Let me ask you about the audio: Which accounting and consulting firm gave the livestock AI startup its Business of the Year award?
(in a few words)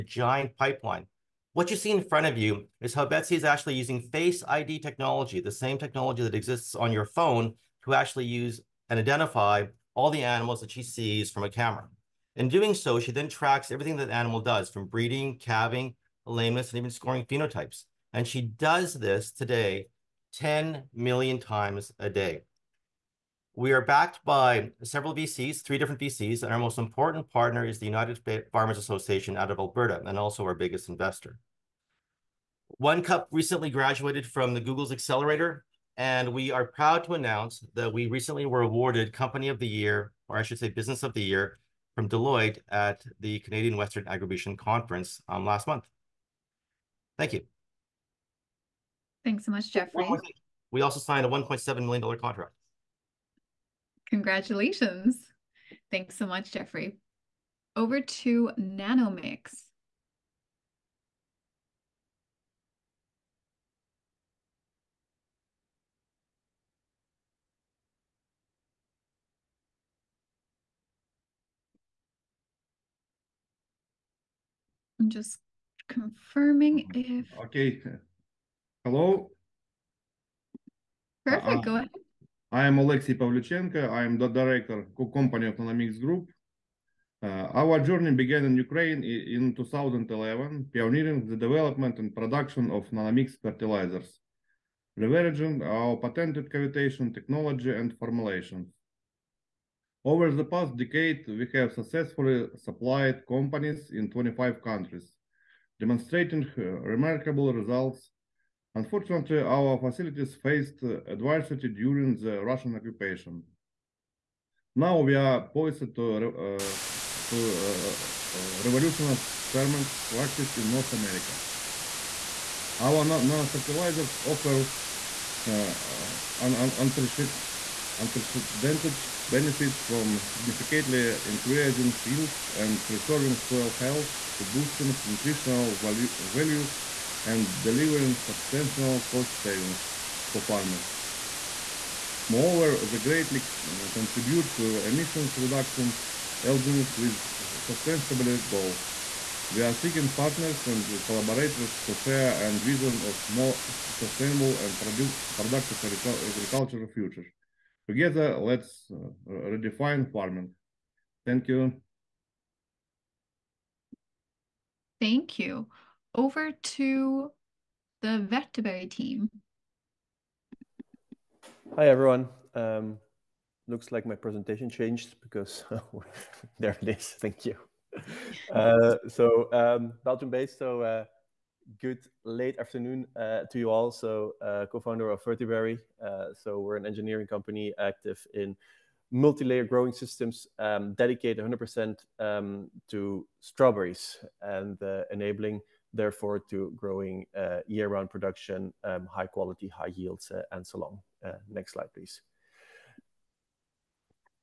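Deloitte.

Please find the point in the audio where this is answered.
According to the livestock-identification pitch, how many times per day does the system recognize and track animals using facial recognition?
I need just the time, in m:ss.
0:20.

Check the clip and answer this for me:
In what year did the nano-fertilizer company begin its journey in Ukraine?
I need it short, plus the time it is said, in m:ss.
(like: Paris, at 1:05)
2011, at 1:29.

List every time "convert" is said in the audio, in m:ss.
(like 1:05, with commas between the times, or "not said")
not said.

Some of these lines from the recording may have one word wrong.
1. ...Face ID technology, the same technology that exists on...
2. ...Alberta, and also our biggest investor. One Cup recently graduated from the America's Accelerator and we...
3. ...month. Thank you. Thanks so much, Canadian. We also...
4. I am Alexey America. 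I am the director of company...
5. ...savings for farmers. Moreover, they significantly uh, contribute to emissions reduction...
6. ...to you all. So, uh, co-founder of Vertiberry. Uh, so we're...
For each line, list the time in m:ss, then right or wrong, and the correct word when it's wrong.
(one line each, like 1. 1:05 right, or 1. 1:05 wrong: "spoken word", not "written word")
1. 0:04 right
2. 0:29 wrong: "Google", not "America"
3. 0:45 wrong: "Jeffrey", not "Canadian"
4. 1:22 wrong: "Pavlichenko", not "America"
5. 2:19 wrong: "greatly", not "significantly"
6. 3:03 right.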